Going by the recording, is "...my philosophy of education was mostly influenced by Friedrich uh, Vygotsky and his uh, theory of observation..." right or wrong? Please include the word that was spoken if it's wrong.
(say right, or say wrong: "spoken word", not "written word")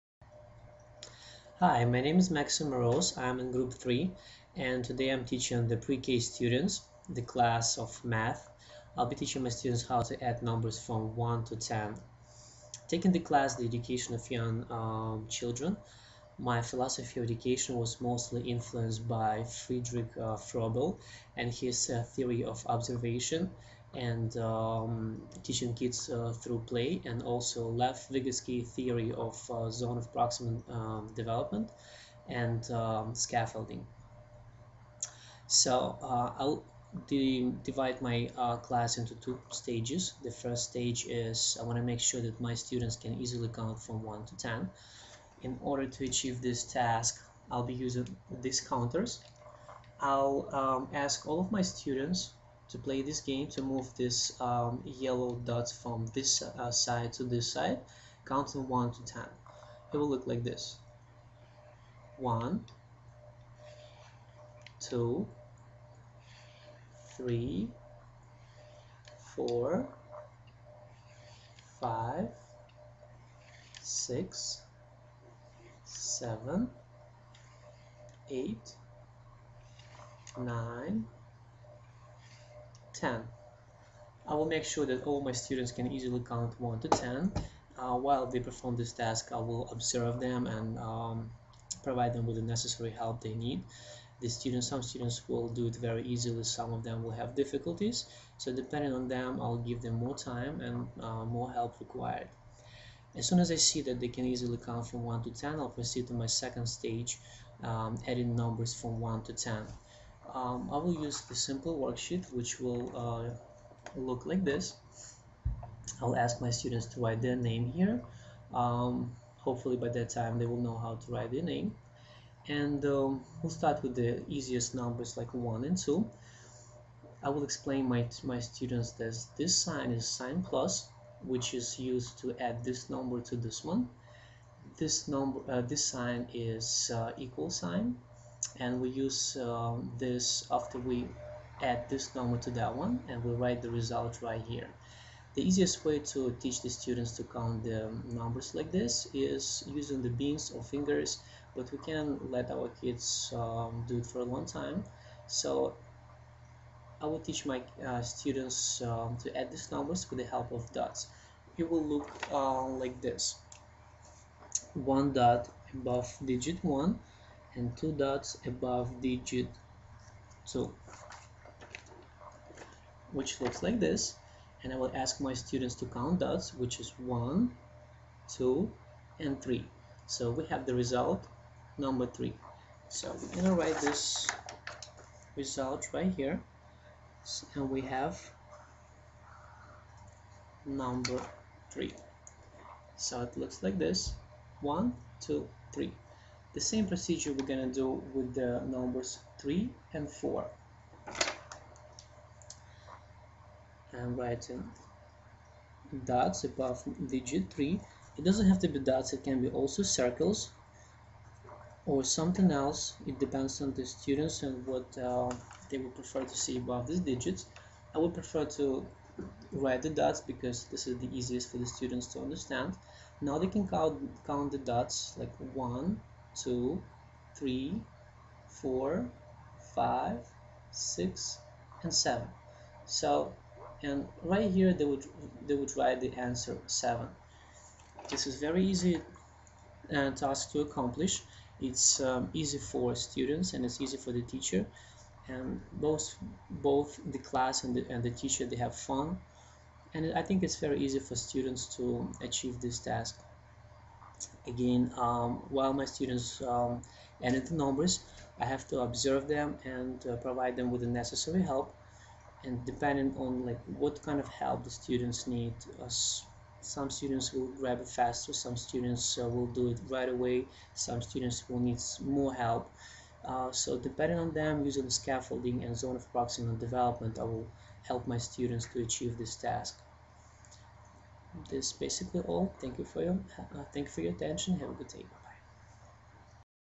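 wrong: "Froebel", not "Vygotsky".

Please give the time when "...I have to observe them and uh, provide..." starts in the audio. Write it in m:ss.
4:18.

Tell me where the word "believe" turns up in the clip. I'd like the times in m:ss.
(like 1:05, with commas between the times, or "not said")
not said.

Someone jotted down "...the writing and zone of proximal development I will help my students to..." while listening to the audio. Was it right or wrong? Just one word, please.
wrong.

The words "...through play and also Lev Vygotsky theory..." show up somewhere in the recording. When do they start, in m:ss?
0:26.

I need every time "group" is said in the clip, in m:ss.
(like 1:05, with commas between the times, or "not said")
0:03.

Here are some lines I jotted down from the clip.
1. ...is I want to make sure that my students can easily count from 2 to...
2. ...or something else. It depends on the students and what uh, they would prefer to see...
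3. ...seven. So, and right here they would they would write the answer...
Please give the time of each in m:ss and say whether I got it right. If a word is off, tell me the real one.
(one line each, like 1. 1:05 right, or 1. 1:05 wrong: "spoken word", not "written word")
1. 0:41 wrong: "1", not "2"
2. 3:31 right
3. 3:51 right.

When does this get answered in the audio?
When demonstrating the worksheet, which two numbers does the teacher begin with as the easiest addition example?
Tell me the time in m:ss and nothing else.
2:05.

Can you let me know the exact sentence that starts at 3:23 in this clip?
I'm writing dots above digit 3.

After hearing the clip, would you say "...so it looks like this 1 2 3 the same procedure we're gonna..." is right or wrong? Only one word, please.
right.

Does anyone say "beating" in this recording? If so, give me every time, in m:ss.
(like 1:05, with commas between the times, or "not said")
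not said.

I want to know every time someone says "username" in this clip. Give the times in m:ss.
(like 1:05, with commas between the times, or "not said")
not said.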